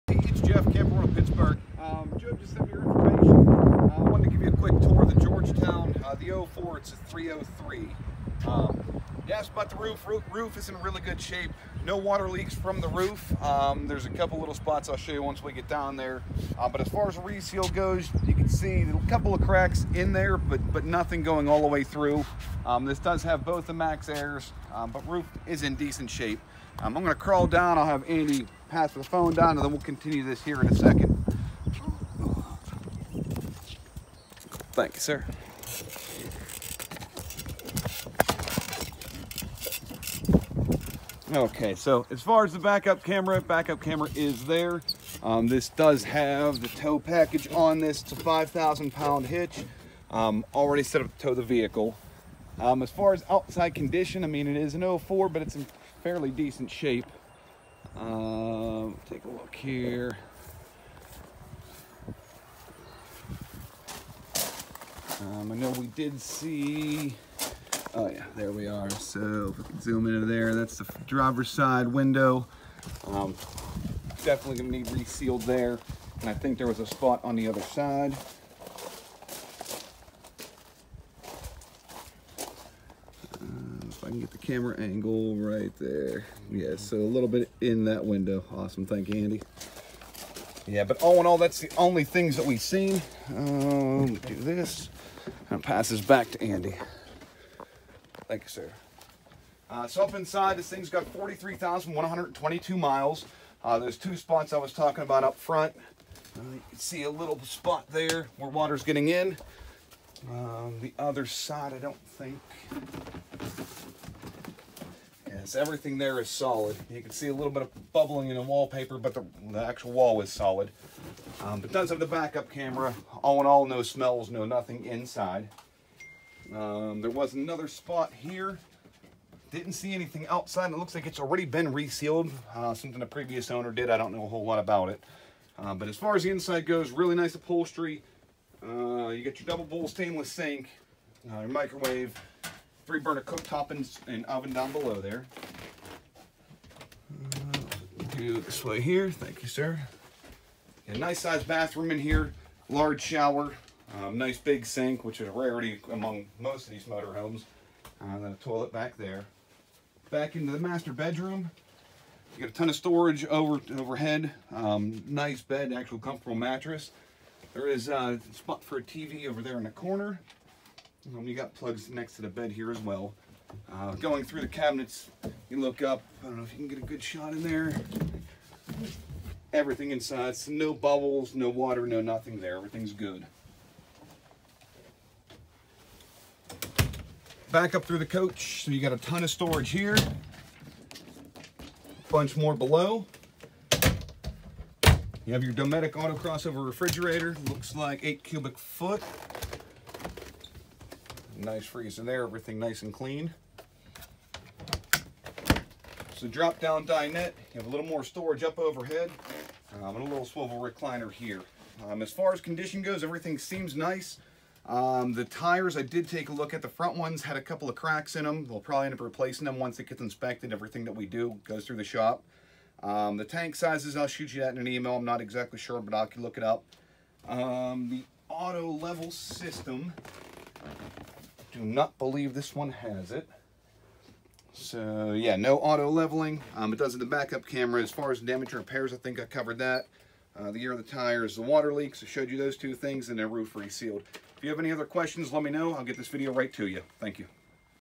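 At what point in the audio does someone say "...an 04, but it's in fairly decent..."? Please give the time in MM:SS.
00:54.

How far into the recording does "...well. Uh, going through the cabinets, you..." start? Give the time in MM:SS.
02:52.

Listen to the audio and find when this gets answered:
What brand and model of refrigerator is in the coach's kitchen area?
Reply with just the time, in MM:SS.
03:15.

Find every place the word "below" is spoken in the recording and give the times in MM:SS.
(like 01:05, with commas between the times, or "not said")
02:24, 03:12.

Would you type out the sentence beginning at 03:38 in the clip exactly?
We'll probably end up replacing them once it gets inspected.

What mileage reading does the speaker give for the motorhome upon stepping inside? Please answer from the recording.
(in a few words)
43,122 miles.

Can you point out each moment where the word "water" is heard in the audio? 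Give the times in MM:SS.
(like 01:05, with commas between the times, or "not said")
00:11, 01:48, 03:01, 04:01.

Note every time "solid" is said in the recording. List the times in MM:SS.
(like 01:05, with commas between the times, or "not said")
01:56, 02:00.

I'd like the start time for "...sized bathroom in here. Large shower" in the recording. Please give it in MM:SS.
02:31.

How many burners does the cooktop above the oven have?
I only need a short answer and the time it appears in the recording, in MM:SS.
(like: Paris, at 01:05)
3, at 02:22.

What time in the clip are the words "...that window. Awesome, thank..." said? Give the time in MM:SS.
01:27.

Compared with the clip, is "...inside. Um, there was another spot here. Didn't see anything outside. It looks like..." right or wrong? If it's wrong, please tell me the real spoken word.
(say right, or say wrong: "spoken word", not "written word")
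right.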